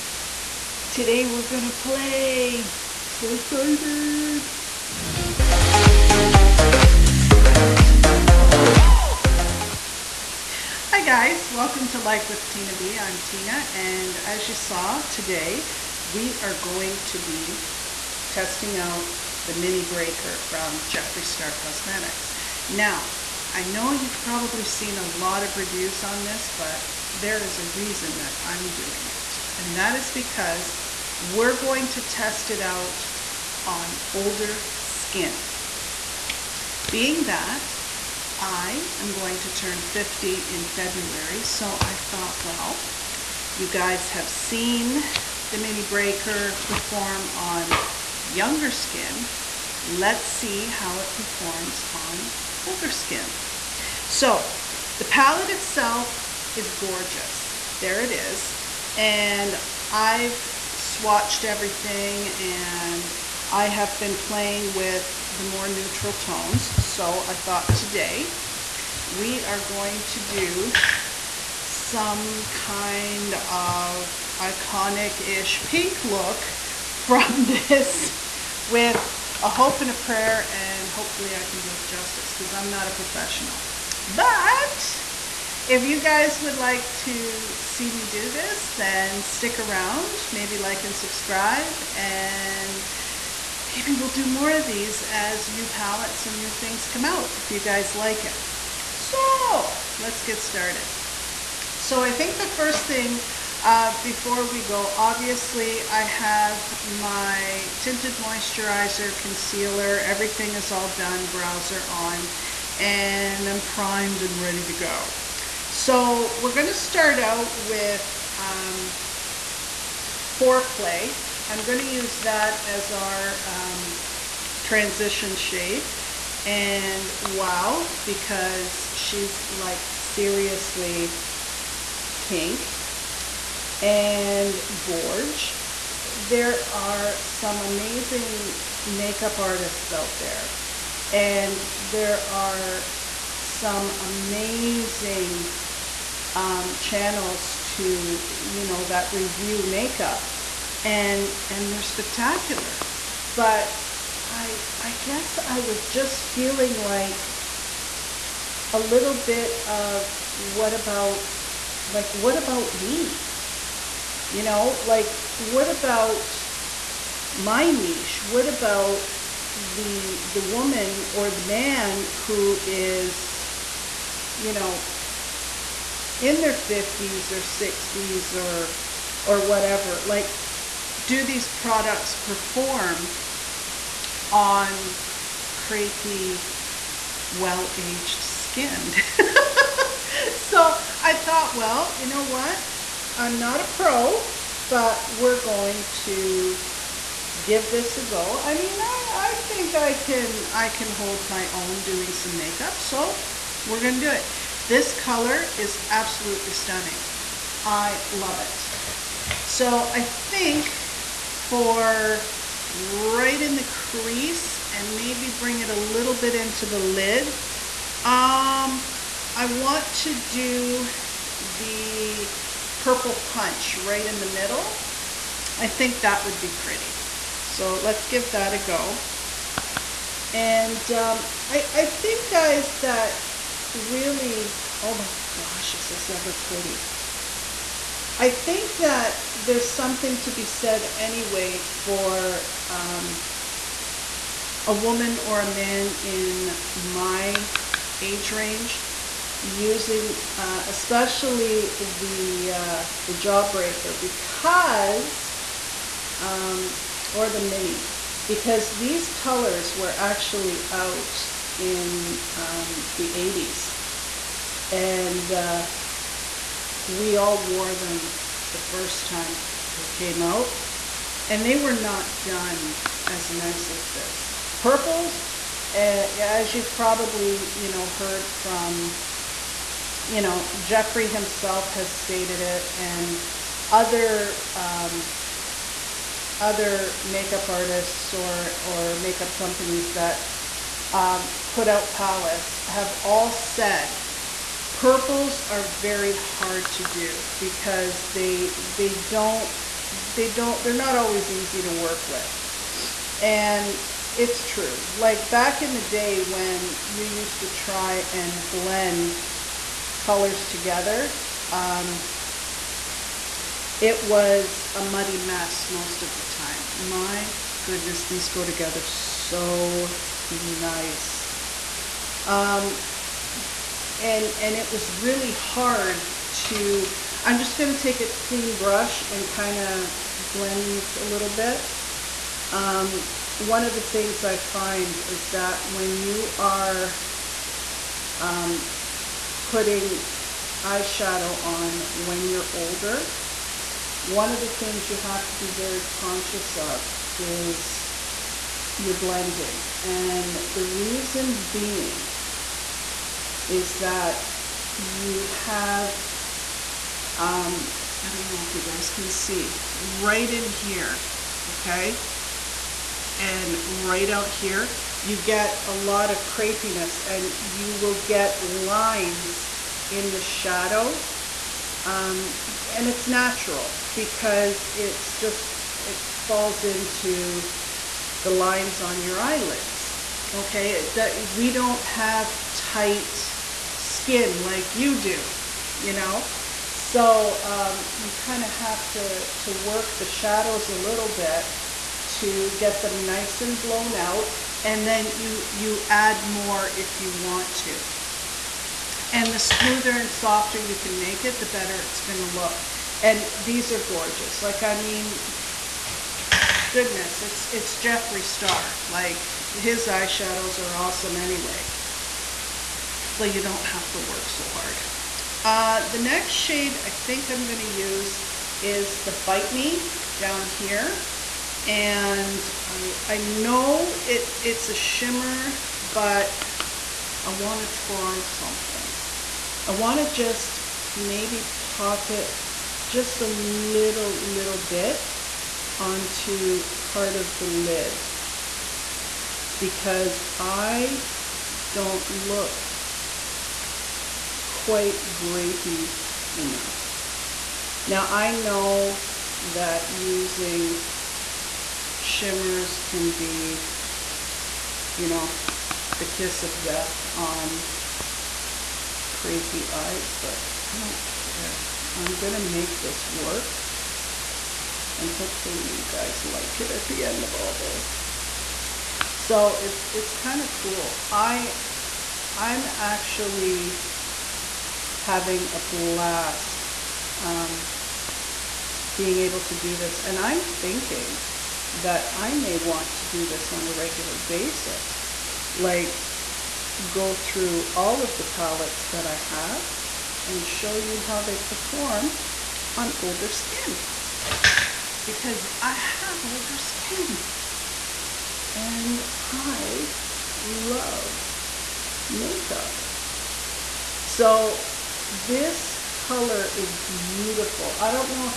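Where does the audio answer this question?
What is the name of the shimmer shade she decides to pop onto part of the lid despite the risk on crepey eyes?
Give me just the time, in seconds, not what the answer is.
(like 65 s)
419 s.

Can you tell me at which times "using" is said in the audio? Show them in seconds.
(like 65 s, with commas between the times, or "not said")
249 s, 449 s.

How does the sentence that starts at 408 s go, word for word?
Like his eyeshadows are awesome anyway.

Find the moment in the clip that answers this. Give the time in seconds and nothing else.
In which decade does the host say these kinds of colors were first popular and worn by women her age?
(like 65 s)
262 s.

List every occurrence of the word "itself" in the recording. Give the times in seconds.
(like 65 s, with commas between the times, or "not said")
55 s.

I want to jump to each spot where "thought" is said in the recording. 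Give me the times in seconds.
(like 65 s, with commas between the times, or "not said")
42 s, 67 s, 191 s.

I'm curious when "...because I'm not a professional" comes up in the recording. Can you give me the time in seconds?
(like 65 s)
82 s.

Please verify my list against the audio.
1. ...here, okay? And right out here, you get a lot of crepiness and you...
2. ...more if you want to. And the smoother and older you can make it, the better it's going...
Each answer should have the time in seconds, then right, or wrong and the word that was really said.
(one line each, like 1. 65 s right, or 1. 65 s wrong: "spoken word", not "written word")
1. 360 s right
2. 396 s wrong: "softer", not "older".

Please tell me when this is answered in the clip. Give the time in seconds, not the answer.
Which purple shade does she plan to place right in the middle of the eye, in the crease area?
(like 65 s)
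222 s.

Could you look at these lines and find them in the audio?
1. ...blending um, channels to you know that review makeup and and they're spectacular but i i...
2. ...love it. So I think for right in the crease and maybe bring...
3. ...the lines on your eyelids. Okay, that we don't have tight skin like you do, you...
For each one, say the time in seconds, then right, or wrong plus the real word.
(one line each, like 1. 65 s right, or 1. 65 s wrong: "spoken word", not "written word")
1. 144 s wrong: "amazing", not "blending"
2. 208 s right
3. 378 s right.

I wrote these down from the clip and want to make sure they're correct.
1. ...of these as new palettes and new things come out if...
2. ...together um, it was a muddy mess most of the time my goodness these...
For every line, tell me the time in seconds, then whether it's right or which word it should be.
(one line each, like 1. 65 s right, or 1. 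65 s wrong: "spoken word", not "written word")
1. 94 s right
2. 310 s right.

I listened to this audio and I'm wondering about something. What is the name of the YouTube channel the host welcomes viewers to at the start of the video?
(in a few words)
Life with Tina B.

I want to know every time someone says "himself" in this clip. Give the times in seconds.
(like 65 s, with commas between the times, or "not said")
281 s.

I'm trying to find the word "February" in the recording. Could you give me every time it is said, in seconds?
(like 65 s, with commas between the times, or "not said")
40 s.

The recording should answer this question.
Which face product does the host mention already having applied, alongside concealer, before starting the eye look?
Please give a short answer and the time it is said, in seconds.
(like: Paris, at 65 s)
tinted moisturizer, at 107 s.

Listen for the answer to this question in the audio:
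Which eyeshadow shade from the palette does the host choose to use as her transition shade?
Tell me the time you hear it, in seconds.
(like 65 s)
120 s.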